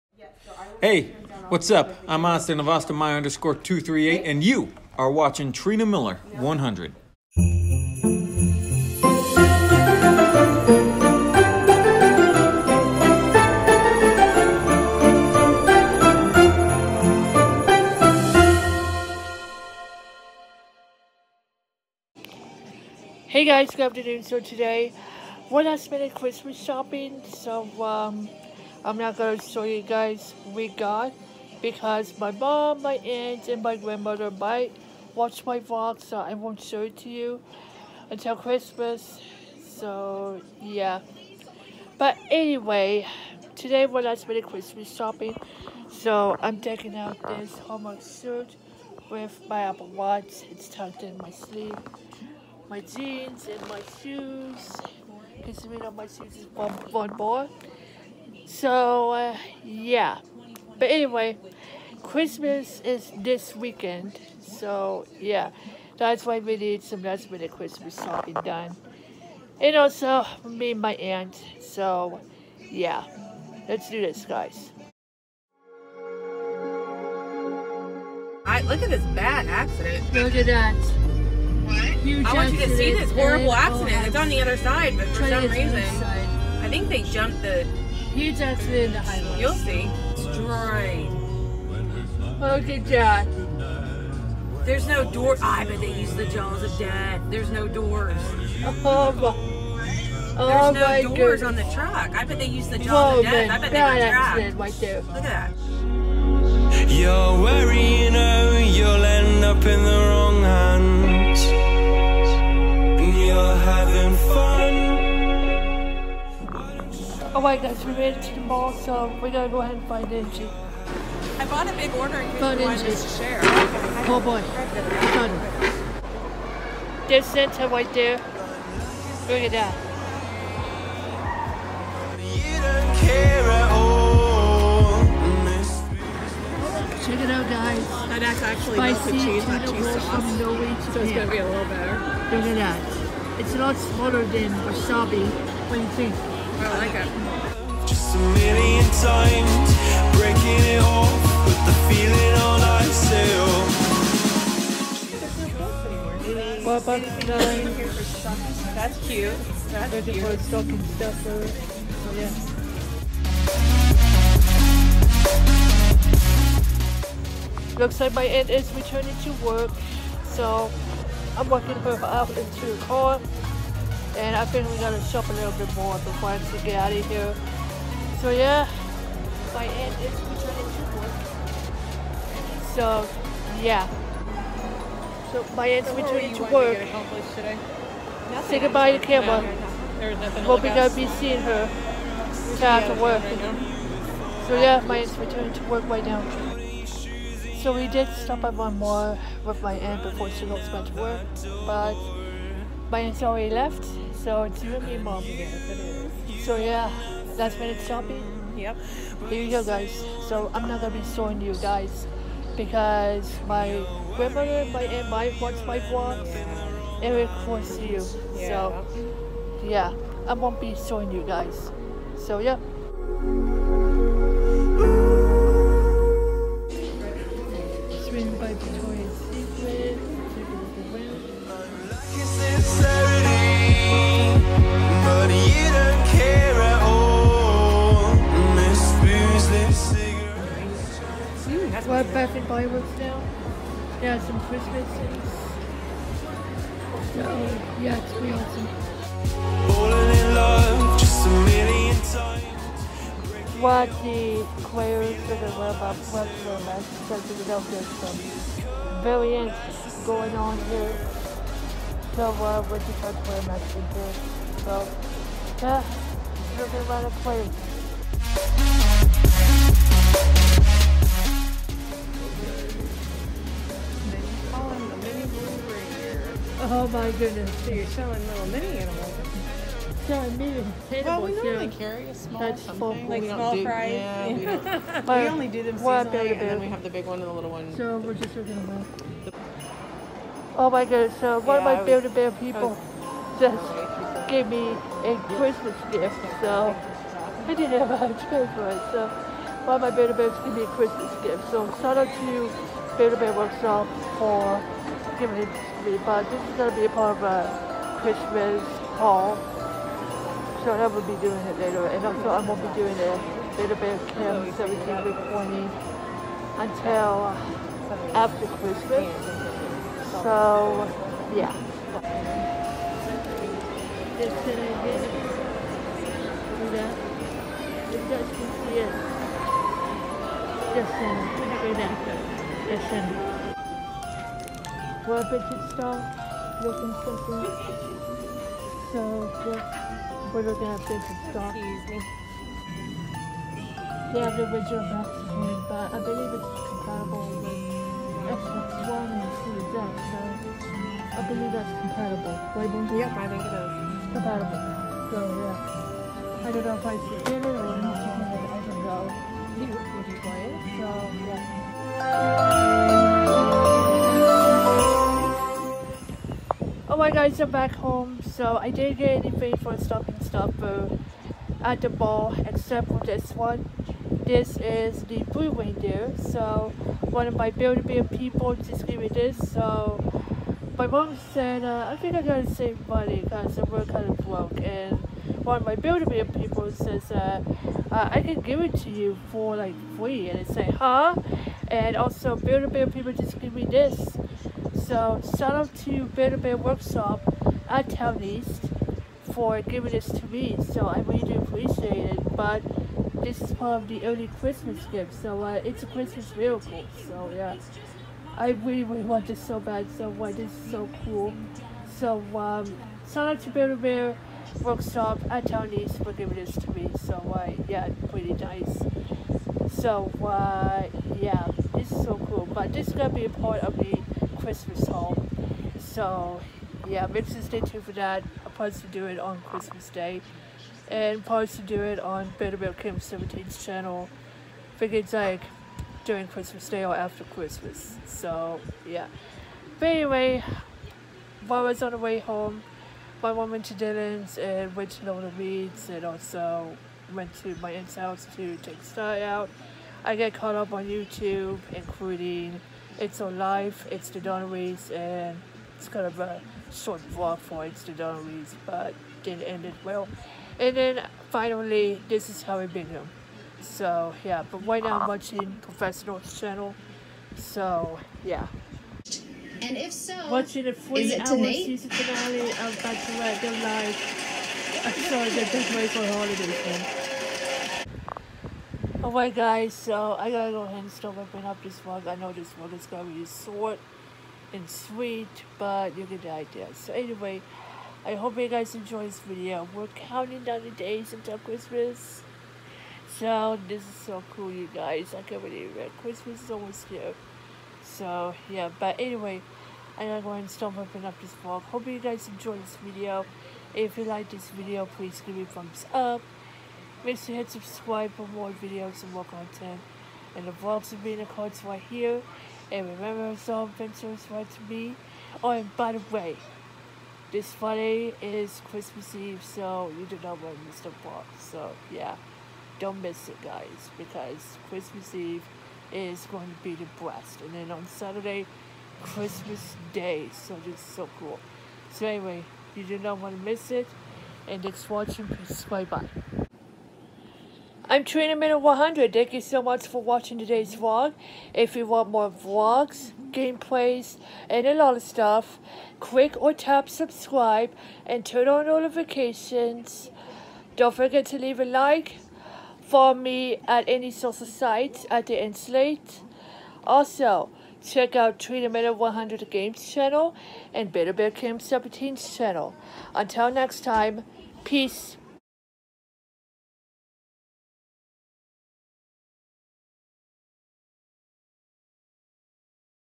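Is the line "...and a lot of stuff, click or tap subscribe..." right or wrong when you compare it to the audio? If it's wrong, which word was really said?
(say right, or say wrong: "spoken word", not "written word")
right.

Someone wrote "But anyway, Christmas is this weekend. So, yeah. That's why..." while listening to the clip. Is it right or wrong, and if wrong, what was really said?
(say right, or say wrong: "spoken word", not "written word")
right.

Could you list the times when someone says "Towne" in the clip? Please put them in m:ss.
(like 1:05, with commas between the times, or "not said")
6:37, 6:55.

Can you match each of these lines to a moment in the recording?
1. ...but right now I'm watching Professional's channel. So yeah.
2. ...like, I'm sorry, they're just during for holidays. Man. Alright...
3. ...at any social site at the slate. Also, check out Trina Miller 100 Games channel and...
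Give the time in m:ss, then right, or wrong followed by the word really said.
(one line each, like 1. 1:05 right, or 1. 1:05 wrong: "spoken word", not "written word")
1. 7:44 right
2. 7:53 wrong: "waiting", not "during"
3. 9:13 right.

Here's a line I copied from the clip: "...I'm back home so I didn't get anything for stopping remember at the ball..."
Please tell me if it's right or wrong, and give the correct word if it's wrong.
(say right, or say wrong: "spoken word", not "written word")
wrong: "stopper", not "remember".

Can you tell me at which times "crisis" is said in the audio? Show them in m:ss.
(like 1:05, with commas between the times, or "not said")
not said.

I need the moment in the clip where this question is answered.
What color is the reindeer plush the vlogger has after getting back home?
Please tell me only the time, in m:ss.
6:15.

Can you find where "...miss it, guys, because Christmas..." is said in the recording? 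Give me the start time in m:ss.
8:43.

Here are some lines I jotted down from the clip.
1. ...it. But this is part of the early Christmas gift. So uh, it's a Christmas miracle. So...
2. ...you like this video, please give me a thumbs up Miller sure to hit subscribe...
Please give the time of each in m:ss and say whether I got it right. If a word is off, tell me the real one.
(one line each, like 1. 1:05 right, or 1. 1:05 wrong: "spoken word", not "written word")
1. 6:42 right
2. 8:23 wrong: "Make", not "Miller".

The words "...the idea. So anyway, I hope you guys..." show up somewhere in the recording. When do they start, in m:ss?
8:06.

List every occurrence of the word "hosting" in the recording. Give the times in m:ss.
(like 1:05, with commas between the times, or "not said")
not said.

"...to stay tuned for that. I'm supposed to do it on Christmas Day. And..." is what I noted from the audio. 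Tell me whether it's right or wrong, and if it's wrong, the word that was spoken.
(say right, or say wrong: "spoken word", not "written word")
right.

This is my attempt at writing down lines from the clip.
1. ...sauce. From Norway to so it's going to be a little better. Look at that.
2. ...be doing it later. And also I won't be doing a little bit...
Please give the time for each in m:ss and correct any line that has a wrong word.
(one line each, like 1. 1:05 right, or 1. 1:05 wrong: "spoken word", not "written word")
1. 2:19 right
2. 5:11 right.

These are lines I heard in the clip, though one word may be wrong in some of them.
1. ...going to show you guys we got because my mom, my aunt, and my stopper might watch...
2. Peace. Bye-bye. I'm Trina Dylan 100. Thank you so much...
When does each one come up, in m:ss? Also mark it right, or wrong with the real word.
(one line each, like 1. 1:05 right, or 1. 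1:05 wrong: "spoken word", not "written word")
1. 0:29 wrong: "grandmother", not "stopper"
2. 8:55 wrong: "Miller", not "Dylan".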